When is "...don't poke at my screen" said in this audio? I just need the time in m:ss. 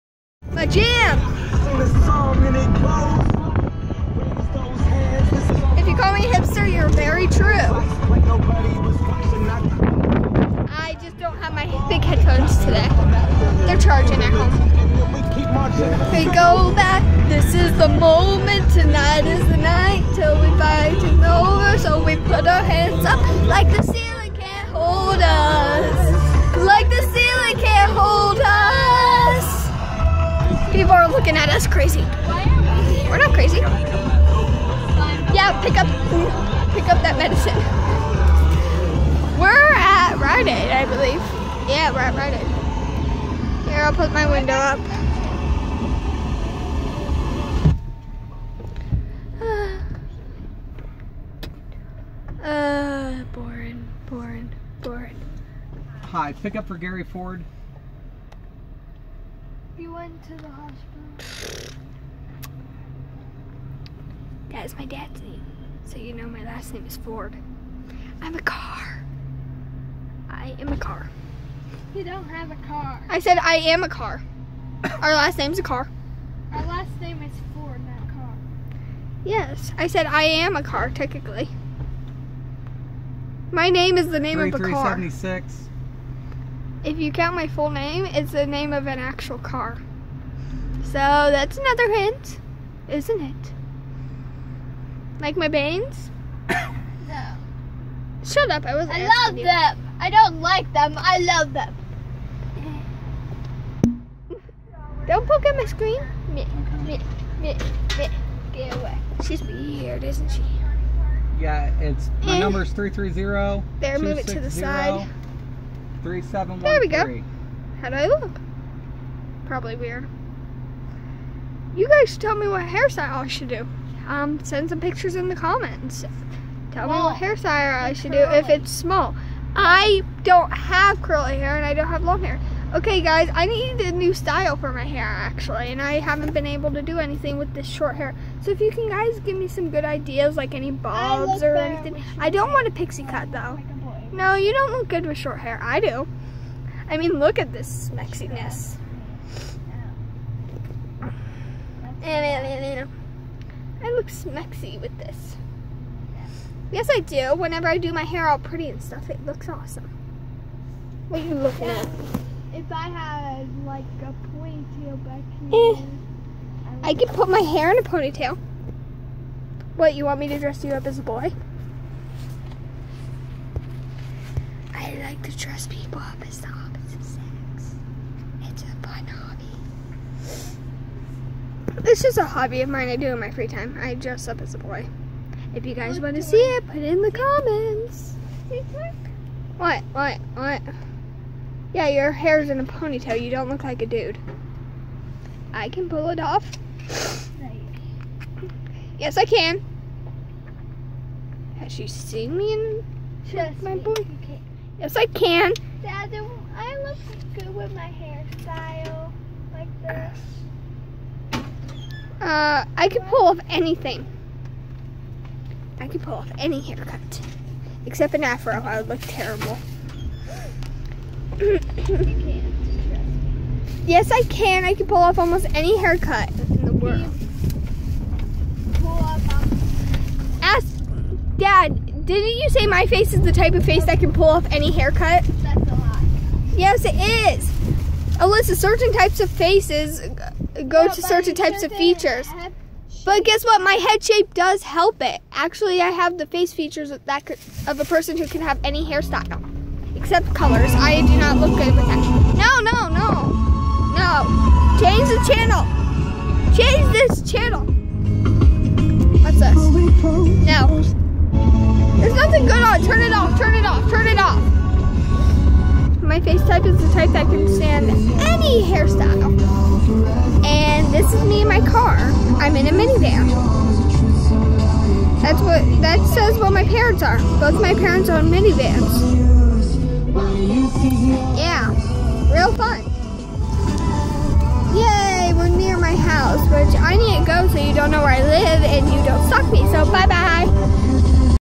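1:45.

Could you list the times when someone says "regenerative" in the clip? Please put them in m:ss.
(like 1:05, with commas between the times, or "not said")
not said.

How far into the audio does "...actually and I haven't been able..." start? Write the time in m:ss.
2:15.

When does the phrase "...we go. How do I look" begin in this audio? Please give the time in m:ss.
1:57.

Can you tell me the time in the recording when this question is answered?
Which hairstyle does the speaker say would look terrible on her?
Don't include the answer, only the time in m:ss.
3:38.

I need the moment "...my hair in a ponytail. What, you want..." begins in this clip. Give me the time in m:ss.
2:47.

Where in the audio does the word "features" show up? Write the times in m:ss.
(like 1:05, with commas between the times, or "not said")
4:01, 4:06.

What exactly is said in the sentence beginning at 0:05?
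If you call me hipster, you're very true.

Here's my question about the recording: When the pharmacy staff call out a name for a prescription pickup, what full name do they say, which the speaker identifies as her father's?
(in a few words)
Gary Ford.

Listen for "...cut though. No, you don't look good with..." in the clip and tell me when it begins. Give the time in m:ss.
2:23.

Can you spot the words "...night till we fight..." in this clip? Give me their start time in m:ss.
0:19.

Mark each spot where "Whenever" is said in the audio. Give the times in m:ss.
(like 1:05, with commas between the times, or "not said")
2:37.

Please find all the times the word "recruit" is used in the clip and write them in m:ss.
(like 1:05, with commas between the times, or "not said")
not said.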